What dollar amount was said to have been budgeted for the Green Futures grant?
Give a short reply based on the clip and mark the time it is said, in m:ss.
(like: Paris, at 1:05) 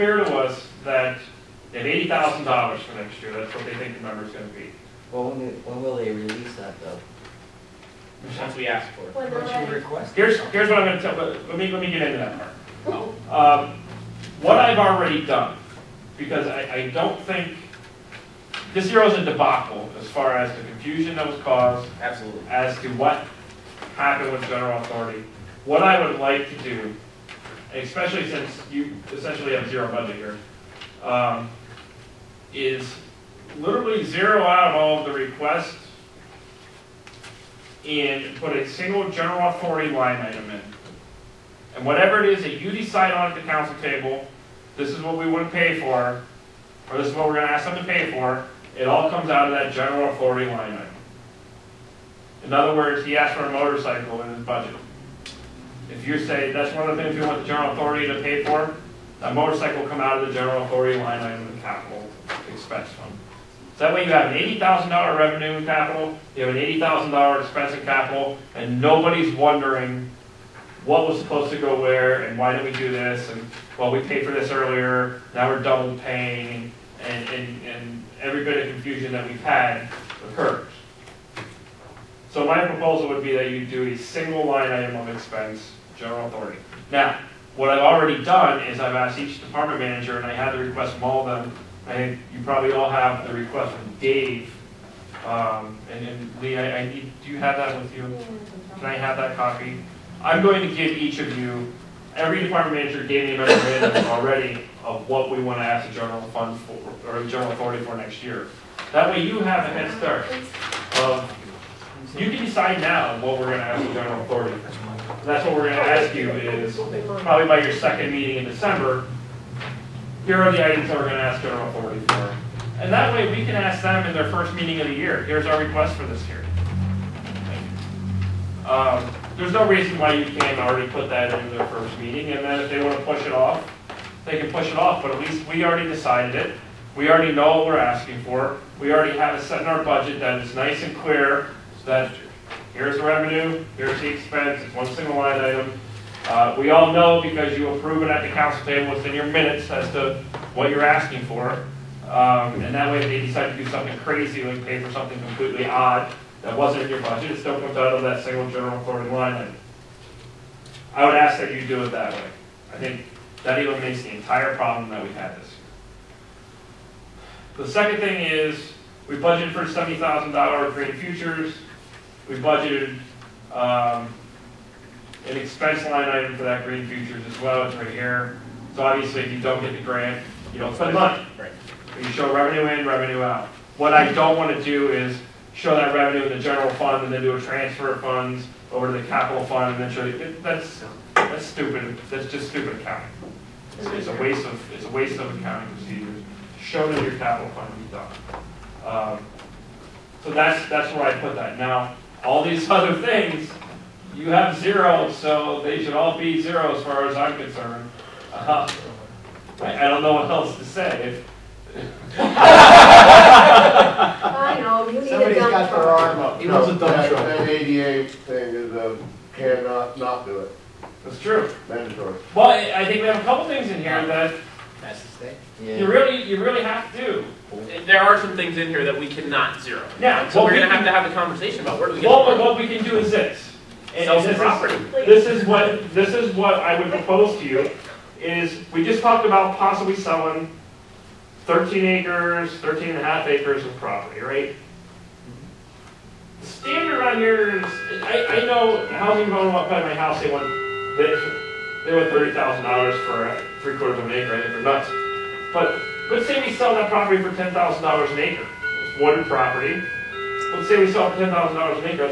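$70,000, at 2:49.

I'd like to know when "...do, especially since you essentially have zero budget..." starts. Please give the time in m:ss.
0:26.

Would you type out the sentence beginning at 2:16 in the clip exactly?
We already know what we're asking for.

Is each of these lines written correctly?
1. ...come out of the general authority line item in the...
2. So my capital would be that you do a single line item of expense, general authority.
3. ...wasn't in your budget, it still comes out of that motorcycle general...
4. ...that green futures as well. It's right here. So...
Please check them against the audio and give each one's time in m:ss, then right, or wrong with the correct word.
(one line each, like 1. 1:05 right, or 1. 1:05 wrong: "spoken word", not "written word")
1. 0:59 right
2. 1:22 wrong: "proposal", not "capital"
3. 2:36 wrong: "single", not "motorcycle"
4. 2:56 right.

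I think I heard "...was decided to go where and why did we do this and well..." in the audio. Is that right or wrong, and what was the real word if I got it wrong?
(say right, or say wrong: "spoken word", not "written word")
wrong: "supposed", not "decided".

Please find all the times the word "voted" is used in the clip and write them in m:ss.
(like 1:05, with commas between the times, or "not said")
not said.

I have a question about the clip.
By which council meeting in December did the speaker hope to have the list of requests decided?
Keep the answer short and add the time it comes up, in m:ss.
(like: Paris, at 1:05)
second meeting, at 1:57.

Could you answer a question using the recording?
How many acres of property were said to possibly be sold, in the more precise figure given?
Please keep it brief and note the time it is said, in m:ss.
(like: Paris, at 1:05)
13.5 acres, at 4:02.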